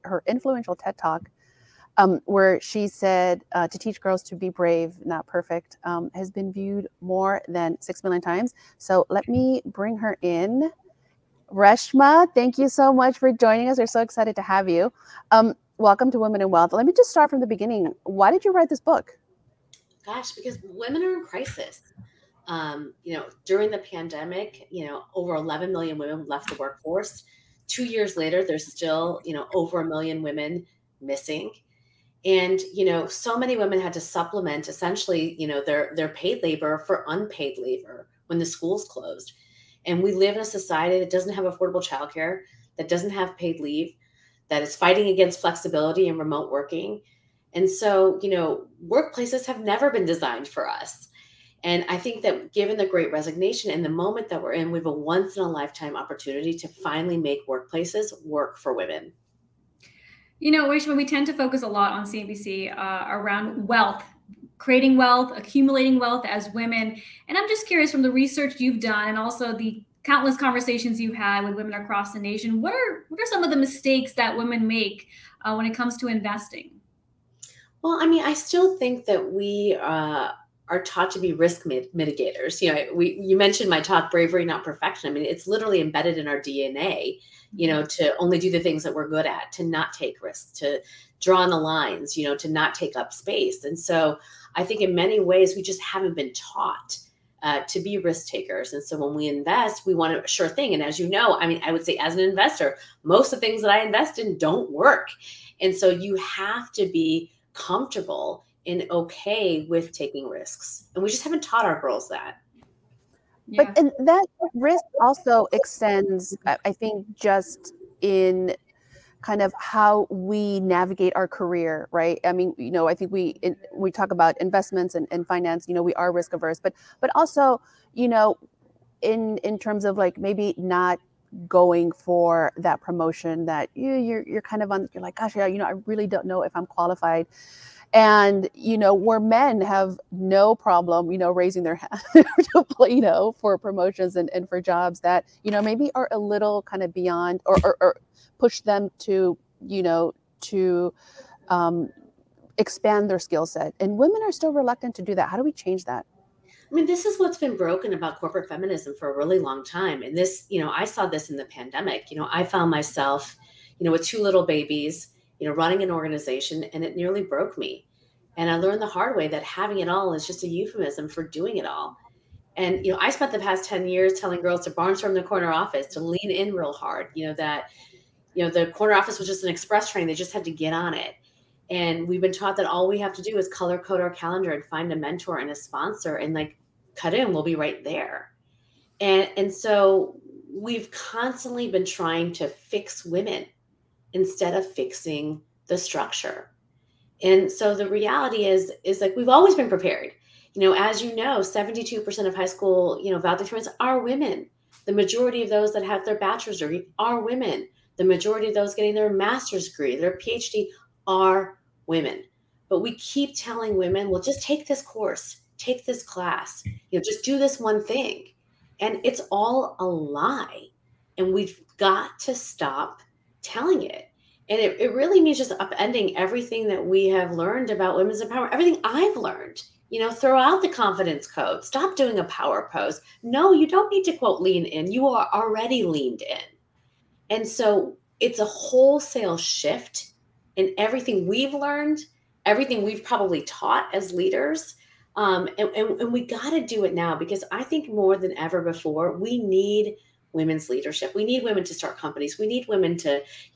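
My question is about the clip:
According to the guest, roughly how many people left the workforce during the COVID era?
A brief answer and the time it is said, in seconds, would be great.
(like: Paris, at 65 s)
over 11 million, at 25 s.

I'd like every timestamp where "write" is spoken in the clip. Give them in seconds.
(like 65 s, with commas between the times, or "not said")
18 s.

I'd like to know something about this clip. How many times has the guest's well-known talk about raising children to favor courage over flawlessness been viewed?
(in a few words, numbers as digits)
more than 6 million.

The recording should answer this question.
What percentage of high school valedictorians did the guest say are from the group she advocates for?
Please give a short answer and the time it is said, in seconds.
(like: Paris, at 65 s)
72%, at 201 s.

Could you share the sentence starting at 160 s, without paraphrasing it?
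And this, you know, I saw this in the pandemic.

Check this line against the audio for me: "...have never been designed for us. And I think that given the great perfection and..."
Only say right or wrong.
wrong.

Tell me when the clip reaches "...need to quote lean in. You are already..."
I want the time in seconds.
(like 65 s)
233 s.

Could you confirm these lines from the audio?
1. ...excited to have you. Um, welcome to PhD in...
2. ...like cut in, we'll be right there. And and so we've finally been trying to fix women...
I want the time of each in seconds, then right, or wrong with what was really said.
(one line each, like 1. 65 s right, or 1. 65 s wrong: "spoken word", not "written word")
1. 14 s wrong: "Women", not "PhD"
2. 186 s wrong: "constantly", not "finally".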